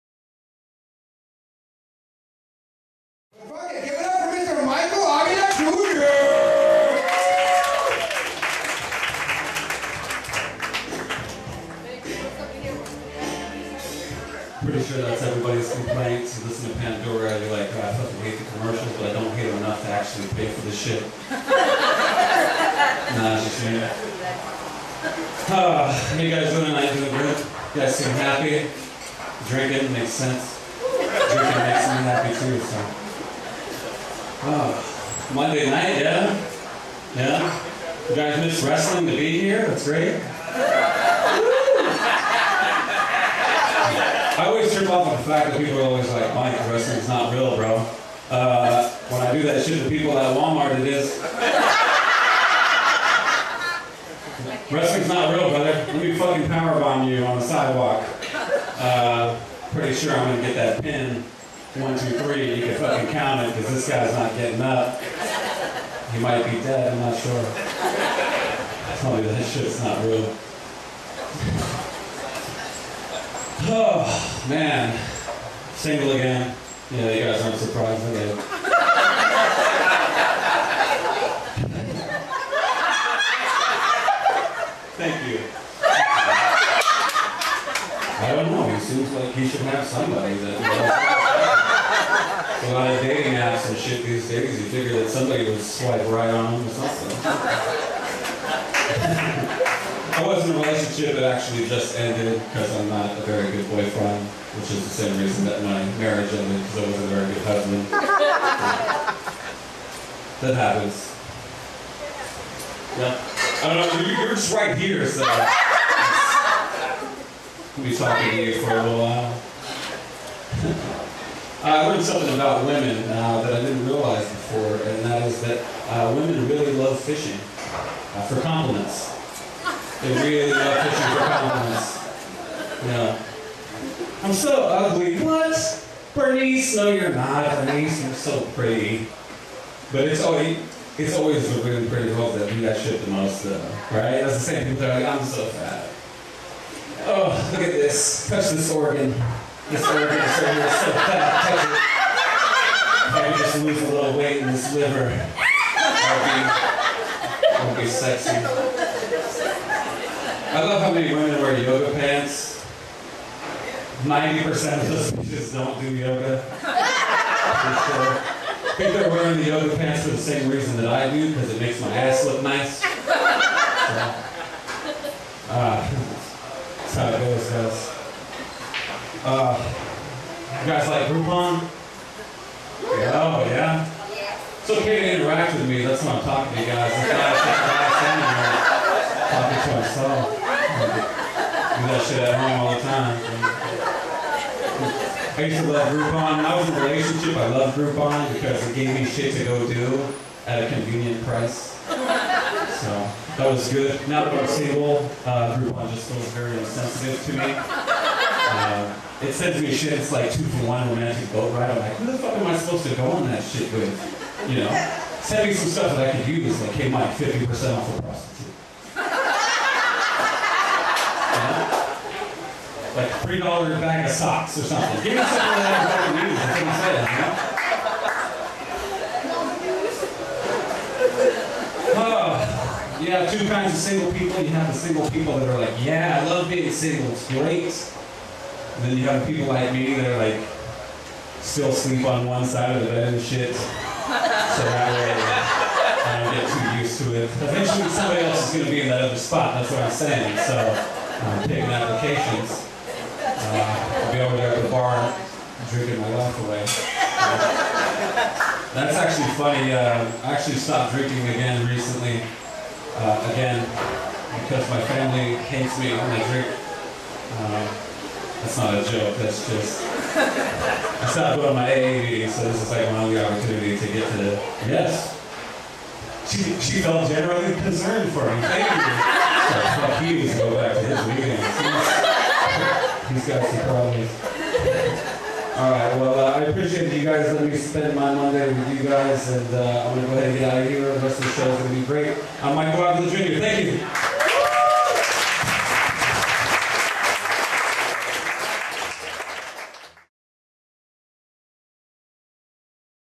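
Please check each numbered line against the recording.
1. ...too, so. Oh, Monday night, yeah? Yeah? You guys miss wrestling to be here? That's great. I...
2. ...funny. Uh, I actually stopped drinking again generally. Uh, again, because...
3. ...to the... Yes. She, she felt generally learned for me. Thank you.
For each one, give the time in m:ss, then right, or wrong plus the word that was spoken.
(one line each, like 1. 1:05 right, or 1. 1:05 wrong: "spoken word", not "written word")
1. 0:32 right
2. 4:19 wrong: "recently", not "generally"
3. 4:34 wrong: "concerned", not "learned".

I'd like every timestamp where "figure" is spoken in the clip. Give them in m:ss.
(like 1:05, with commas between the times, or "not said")
1:34.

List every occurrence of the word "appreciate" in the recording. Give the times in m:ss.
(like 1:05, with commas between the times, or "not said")
4:46.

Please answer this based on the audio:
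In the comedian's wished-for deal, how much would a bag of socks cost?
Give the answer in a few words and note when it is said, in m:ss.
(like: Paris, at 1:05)
$3, at 3:43.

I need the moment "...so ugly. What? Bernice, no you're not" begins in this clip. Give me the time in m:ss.
2:14.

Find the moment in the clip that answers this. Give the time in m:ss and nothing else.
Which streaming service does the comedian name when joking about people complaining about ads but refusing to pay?
0:16.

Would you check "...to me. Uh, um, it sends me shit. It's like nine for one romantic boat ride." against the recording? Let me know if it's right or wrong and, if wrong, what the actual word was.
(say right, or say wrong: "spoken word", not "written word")
wrong: "two", not "nine".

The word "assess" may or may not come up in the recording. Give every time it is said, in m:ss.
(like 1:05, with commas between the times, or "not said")
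not said.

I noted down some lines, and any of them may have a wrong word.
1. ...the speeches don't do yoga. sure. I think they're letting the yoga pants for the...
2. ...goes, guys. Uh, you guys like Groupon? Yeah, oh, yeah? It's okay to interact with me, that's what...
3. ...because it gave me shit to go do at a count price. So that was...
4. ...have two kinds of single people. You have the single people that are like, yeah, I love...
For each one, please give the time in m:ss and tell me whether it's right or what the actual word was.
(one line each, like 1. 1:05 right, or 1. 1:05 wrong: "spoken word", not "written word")
1. 2:44 wrong: "wearing", not "letting"
2. 2:57 right
3. 3:18 wrong: "convenient", not "count"
4. 3:53 right.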